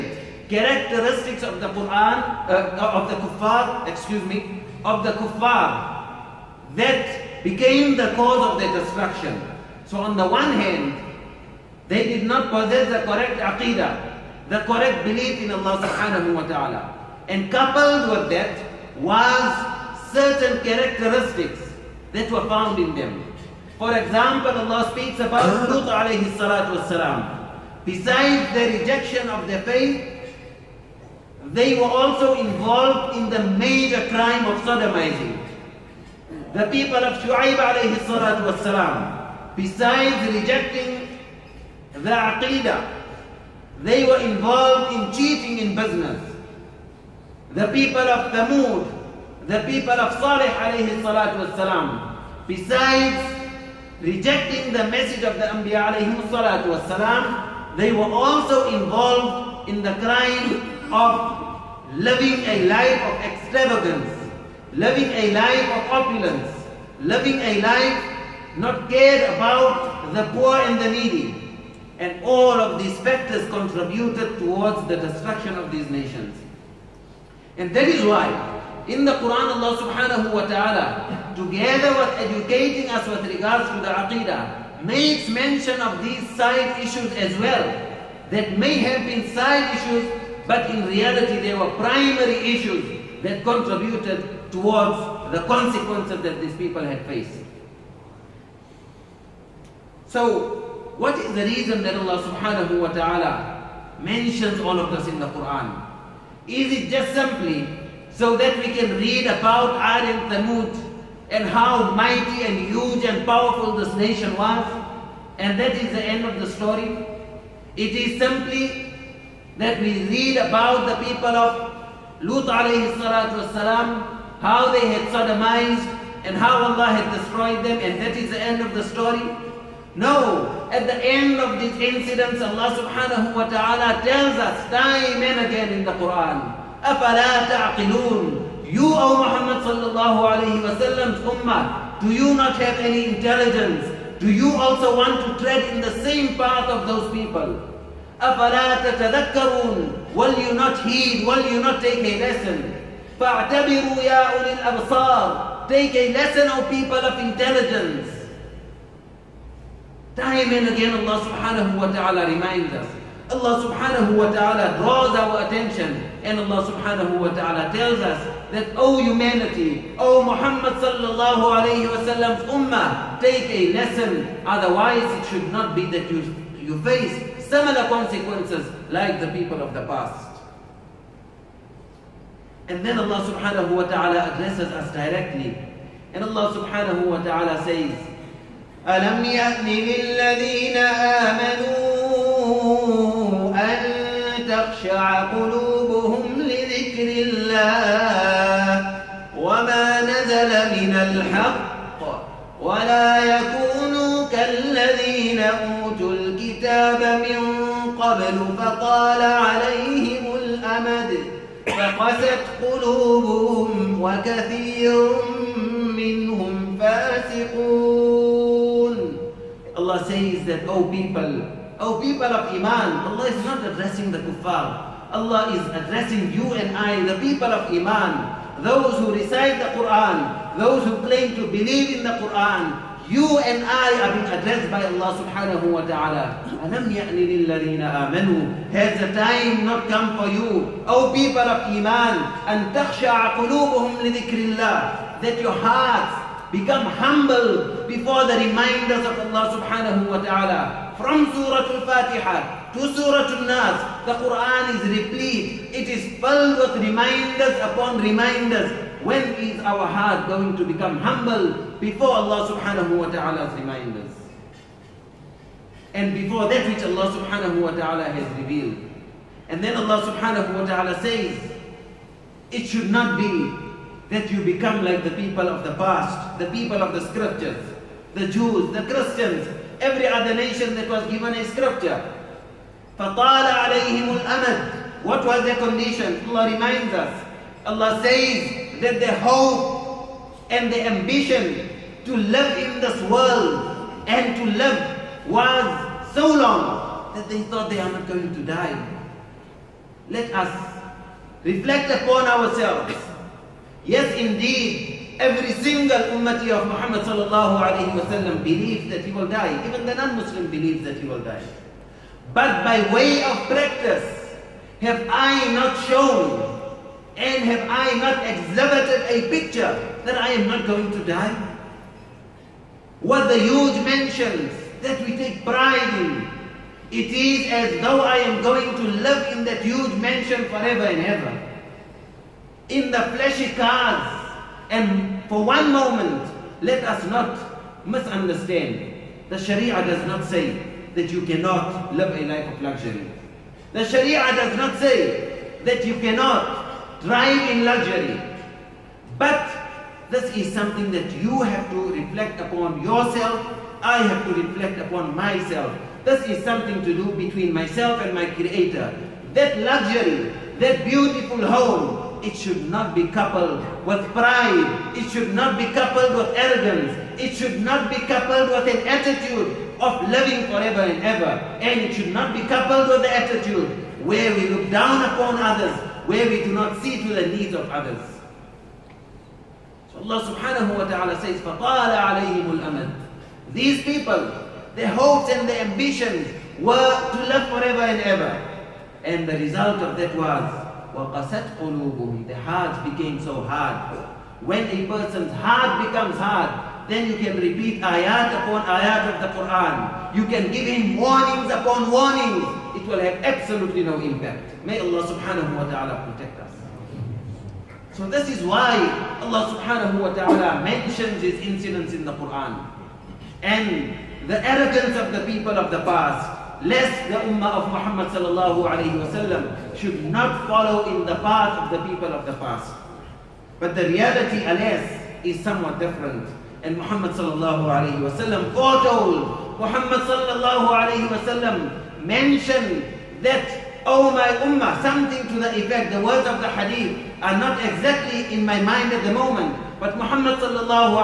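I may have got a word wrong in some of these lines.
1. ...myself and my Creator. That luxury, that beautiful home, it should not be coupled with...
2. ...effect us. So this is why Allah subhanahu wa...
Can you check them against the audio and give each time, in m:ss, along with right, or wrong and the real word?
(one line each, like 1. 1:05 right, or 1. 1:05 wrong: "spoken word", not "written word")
1. 5:57 right
2. 6:46 wrong: "protect", not "effect".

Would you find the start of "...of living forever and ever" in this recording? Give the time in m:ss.
6:09.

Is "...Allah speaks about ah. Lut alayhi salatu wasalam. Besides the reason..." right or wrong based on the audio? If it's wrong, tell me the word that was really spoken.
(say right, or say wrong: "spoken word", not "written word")
wrong: "rejection", not "reason".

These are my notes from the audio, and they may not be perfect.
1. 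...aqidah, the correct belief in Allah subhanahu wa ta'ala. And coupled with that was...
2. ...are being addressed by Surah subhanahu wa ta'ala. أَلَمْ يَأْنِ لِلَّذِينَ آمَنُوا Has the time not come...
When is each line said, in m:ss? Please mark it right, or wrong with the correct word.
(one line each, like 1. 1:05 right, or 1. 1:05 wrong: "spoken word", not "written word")
1. 0:13 right
2. 3:54 wrong: "Allah", not "Surah".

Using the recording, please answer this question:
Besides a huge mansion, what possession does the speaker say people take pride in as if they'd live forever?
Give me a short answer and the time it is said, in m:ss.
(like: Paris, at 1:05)
fleshy cars, at 5:32.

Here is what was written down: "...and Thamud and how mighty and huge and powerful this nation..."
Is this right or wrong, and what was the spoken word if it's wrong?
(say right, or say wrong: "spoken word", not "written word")
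right.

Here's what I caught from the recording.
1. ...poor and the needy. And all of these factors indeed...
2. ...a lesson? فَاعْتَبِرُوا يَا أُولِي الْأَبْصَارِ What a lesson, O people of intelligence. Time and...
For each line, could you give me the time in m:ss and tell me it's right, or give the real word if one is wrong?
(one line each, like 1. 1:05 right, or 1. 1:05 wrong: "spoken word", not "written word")
1. 1:10 wrong: "contributed", not "indeed"
2. 2:32 wrong: "Take", not "What".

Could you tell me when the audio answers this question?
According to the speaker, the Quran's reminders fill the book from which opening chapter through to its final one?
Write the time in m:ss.
4:11.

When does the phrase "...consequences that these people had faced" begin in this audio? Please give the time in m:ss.
1:35.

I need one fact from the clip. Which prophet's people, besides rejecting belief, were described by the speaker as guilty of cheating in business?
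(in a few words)
Shu'aib.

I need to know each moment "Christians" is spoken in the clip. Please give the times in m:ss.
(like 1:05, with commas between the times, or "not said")
4:38.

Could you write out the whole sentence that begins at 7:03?
But the reality, alas, is somewhat different.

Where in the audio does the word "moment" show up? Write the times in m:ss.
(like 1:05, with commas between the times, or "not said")
5:35, 7:19.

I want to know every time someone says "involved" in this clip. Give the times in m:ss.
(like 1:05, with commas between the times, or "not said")
0:32, 0:44, 0:58.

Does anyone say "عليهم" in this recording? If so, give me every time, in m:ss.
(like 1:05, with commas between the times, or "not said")
3:29, 4:43, 6:22.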